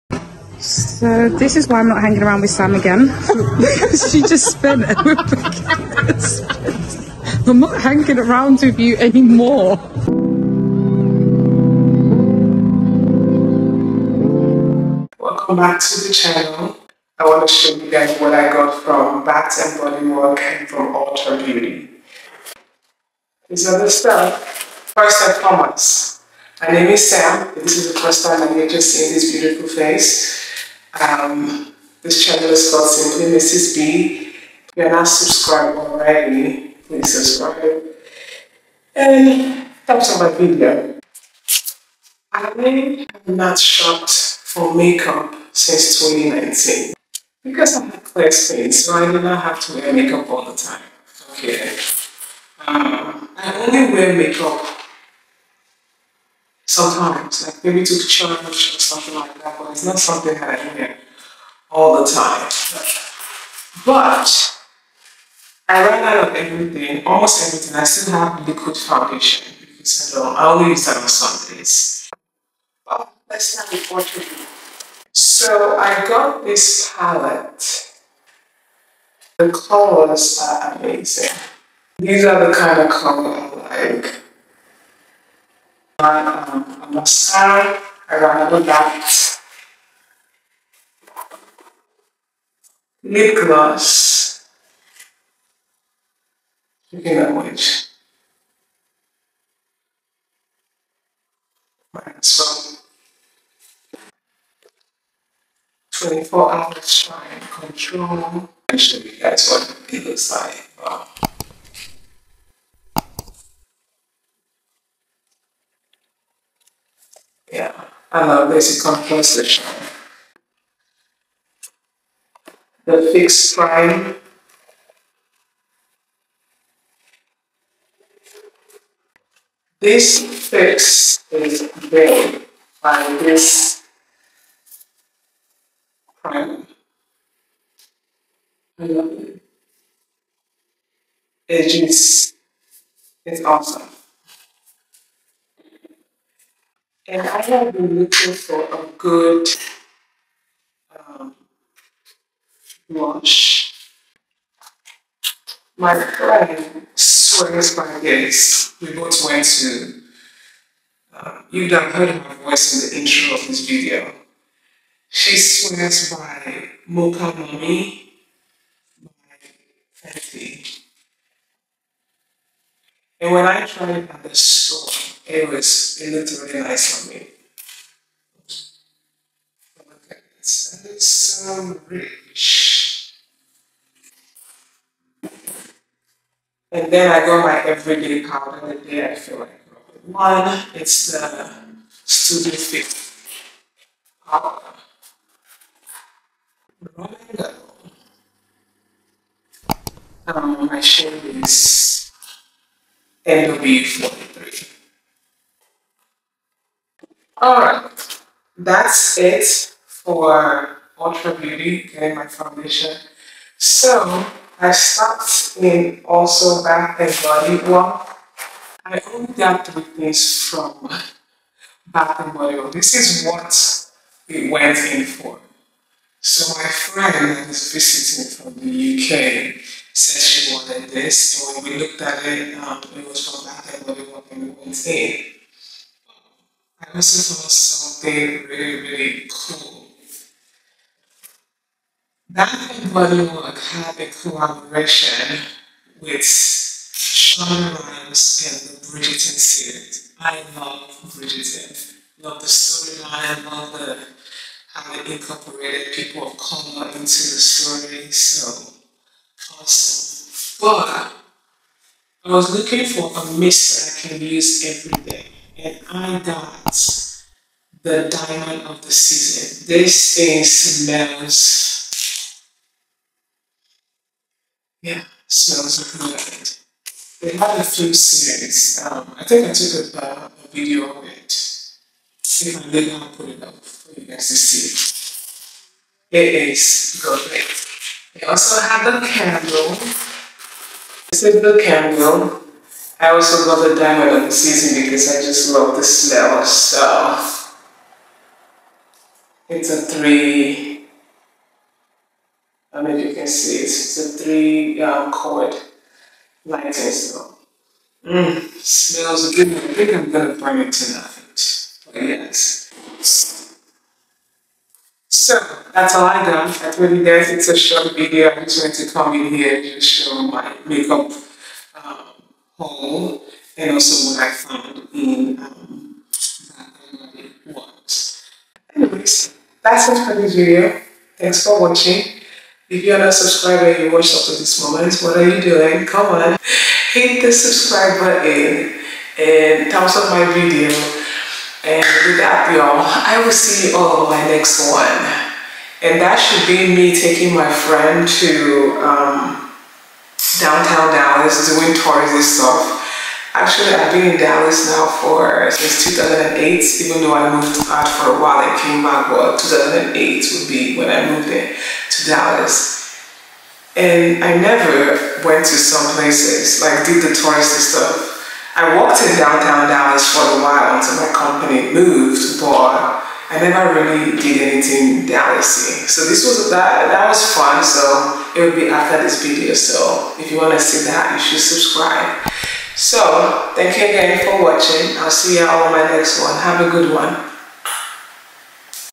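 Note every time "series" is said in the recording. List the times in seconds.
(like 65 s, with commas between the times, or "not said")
249 s, 277 s.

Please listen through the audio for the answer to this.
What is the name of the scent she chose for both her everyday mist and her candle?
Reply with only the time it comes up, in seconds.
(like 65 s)
268 s.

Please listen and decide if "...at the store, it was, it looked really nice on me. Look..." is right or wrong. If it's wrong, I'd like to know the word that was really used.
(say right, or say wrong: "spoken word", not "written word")
right.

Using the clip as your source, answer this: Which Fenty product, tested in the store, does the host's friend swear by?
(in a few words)
Mocha Mami.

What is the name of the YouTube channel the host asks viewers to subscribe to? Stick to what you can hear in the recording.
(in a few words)
Simply Mrs. 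B.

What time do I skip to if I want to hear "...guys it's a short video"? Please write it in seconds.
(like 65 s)
317 s.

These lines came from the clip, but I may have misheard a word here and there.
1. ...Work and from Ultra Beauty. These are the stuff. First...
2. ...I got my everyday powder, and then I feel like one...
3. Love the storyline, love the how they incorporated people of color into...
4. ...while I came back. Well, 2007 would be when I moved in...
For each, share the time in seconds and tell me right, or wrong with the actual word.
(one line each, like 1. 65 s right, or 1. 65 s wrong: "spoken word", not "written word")
1. 20 s right
2. 187 s right
3. 252 s right
4. 358 s wrong: "2008", not "2007".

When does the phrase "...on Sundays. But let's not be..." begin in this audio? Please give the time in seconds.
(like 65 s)
70 s.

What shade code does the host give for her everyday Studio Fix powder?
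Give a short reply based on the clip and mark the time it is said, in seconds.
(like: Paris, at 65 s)
NW40, at 203 s.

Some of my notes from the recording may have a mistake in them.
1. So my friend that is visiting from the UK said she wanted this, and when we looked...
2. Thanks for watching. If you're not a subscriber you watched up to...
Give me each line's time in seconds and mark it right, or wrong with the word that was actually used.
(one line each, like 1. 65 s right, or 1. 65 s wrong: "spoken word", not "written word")
1. 226 s right
2. 331 s right.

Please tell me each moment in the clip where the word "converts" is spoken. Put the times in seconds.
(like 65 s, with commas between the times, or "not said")
not said.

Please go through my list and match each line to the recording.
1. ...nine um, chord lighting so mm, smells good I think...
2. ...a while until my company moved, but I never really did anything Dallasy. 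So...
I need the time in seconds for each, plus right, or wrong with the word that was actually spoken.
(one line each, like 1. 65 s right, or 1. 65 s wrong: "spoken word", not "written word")
1. 304 s wrong: "three", not "nine"
2. 370 s right.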